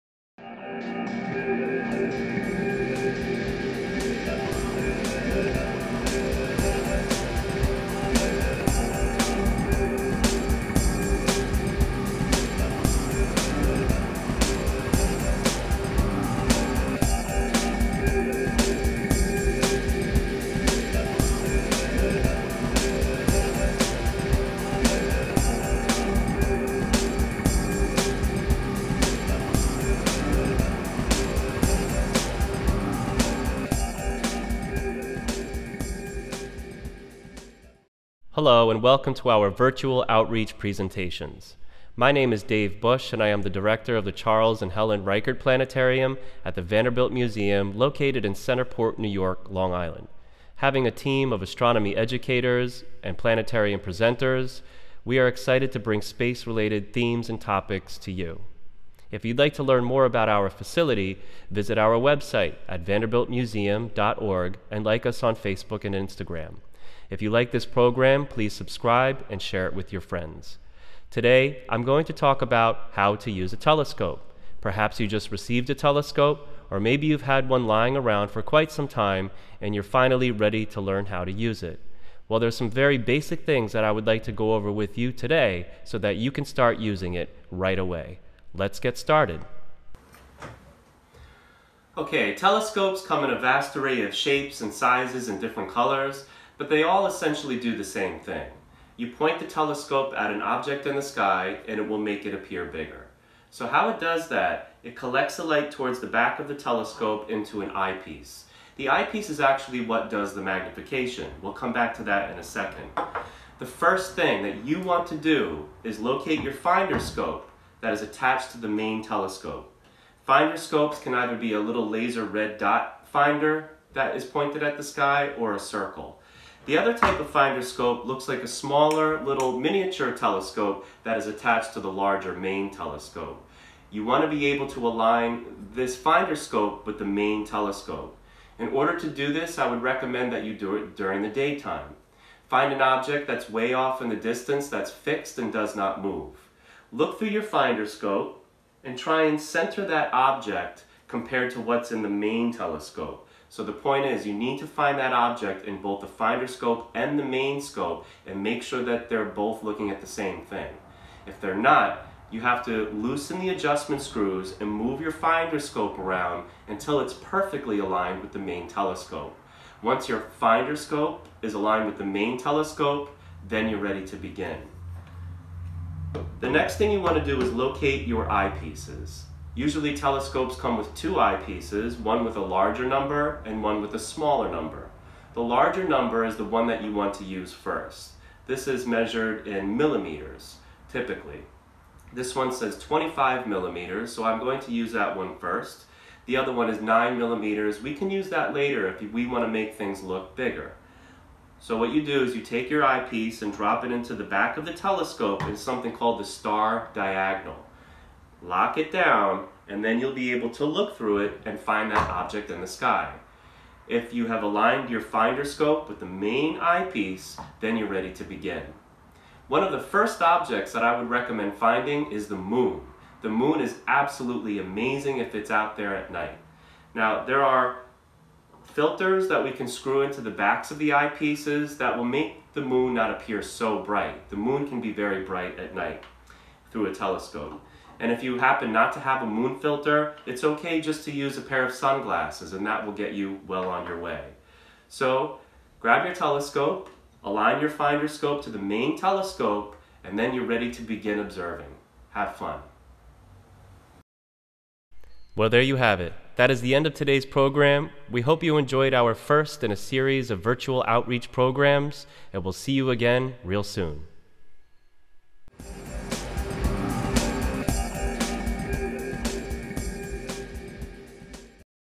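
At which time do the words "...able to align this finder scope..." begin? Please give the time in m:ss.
2:14.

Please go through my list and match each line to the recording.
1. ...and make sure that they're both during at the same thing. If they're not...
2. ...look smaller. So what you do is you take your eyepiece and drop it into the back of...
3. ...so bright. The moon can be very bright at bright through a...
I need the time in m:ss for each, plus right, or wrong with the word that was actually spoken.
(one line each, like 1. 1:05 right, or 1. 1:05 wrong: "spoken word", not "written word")
1. 2:38 wrong: "looking", not "during"
2. 3:20 wrong: "bigger", not "smaller"
3. 3:53 wrong: "night", not "bright".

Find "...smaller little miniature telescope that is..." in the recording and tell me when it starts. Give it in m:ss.
2:08.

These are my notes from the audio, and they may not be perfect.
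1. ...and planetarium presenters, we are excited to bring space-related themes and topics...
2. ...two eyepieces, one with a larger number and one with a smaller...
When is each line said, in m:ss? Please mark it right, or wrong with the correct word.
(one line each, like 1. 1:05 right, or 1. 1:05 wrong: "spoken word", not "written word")
1. 0:53 right
2. 3:00 right.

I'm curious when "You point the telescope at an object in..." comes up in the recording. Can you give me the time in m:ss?
1:38.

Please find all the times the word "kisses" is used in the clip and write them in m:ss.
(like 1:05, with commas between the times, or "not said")
not said.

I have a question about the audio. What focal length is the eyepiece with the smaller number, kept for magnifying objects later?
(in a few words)
9 millimeters.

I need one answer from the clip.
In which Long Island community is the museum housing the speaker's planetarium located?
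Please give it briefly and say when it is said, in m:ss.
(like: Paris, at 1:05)
Centerport, at 0:48.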